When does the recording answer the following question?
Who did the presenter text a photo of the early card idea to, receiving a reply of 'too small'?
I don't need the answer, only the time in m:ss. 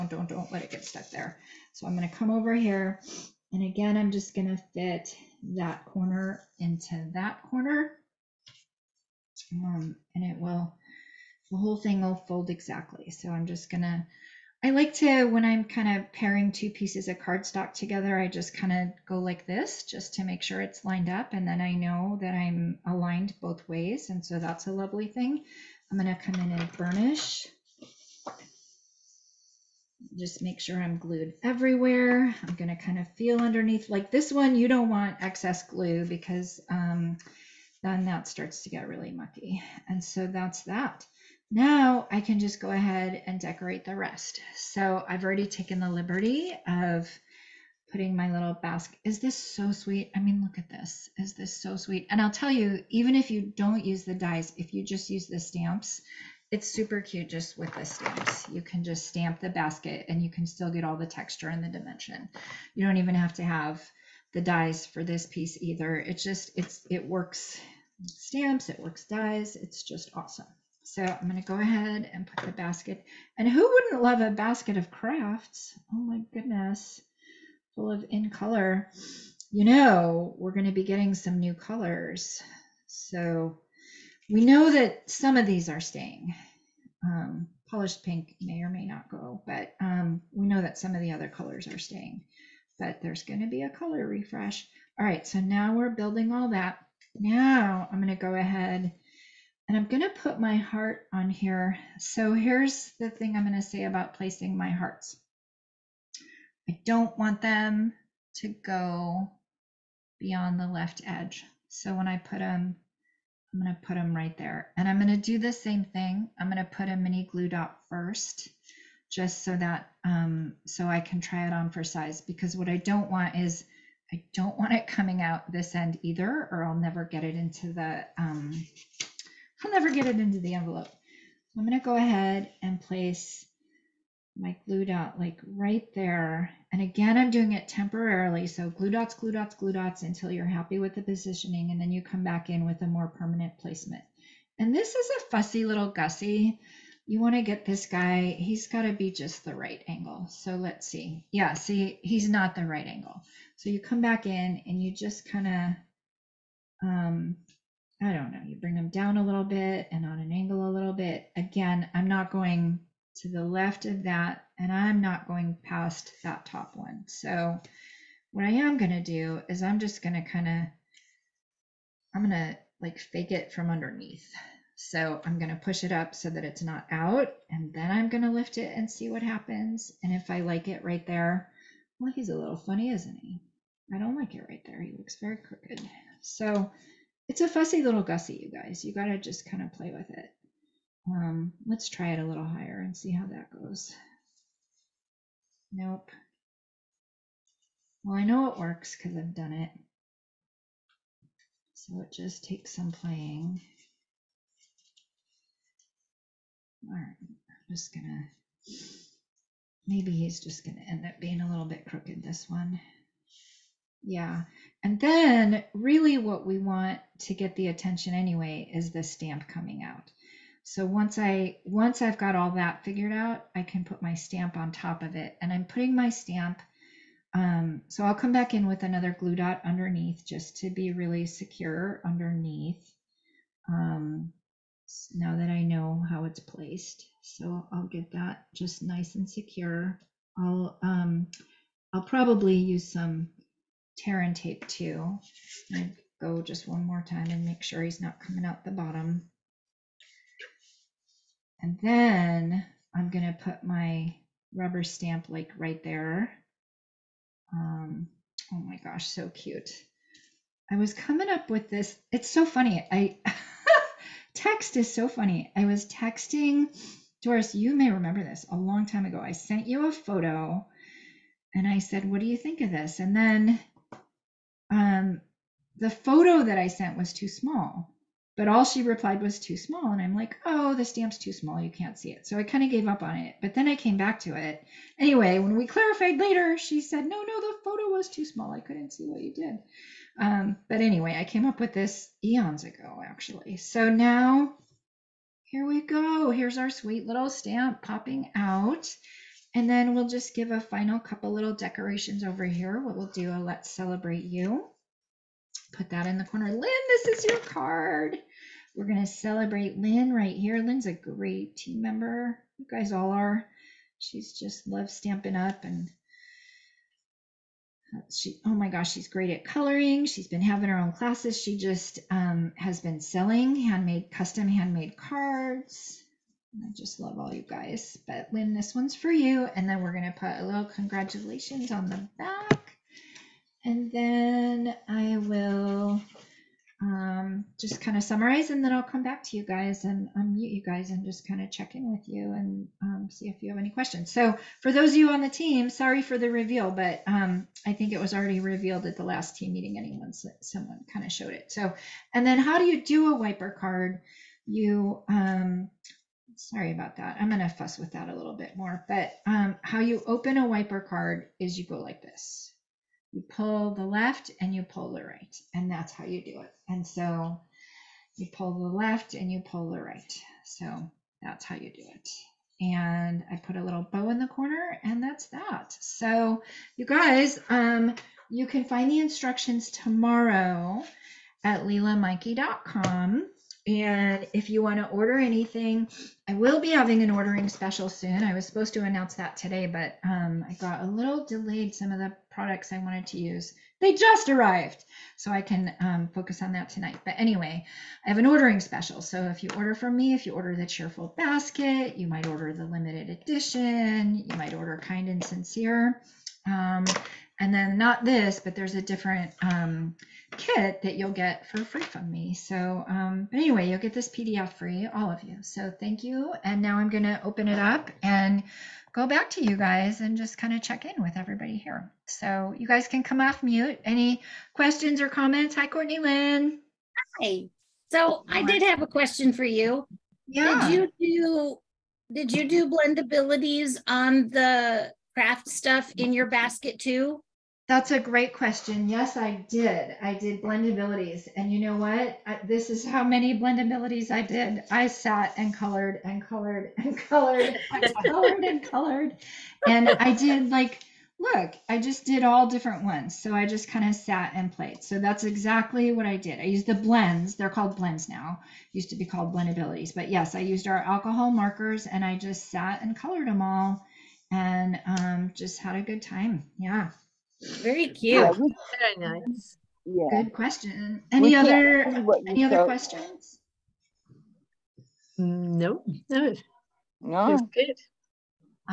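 4:27.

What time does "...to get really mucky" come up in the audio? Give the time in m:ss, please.
0:38.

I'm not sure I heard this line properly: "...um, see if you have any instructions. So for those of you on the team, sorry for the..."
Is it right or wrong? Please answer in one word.
wrong.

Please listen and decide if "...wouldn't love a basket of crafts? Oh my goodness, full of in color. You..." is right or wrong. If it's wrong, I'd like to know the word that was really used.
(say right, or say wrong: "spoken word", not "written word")
right.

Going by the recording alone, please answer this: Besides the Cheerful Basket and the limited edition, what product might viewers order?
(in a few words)
Kind and Sincere.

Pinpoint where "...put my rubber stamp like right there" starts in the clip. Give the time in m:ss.
4:13.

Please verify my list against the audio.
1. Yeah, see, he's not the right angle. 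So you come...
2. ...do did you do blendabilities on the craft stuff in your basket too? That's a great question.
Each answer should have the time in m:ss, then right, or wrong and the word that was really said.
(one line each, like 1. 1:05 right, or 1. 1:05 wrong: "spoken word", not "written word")
1. 2:31 right
2. 7:11 right.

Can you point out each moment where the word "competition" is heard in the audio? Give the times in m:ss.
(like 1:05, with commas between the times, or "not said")
not said.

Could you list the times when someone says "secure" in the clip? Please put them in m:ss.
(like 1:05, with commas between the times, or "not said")
3:51, 3:59.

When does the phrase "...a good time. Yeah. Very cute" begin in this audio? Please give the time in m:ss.
7:45.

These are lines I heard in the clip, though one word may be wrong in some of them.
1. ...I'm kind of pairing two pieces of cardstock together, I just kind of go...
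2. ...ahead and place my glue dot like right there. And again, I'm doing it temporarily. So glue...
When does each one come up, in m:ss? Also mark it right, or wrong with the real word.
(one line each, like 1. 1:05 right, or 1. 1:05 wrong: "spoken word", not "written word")
1. 0:15 right
2. 2:11 right.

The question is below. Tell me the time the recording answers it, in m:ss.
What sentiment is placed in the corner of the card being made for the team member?
5:03.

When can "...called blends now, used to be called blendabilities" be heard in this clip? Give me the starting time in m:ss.
7:37.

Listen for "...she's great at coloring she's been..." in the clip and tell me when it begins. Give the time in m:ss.
5:18.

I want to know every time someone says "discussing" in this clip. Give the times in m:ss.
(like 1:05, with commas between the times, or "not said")
not said.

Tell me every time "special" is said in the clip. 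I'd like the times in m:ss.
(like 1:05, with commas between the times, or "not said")
6:27, 6:38.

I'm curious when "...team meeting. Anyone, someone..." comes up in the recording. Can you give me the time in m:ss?
5:49.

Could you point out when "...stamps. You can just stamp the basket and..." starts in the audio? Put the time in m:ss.
0:57.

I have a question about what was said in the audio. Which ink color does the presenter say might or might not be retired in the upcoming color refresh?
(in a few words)
Polished Pink.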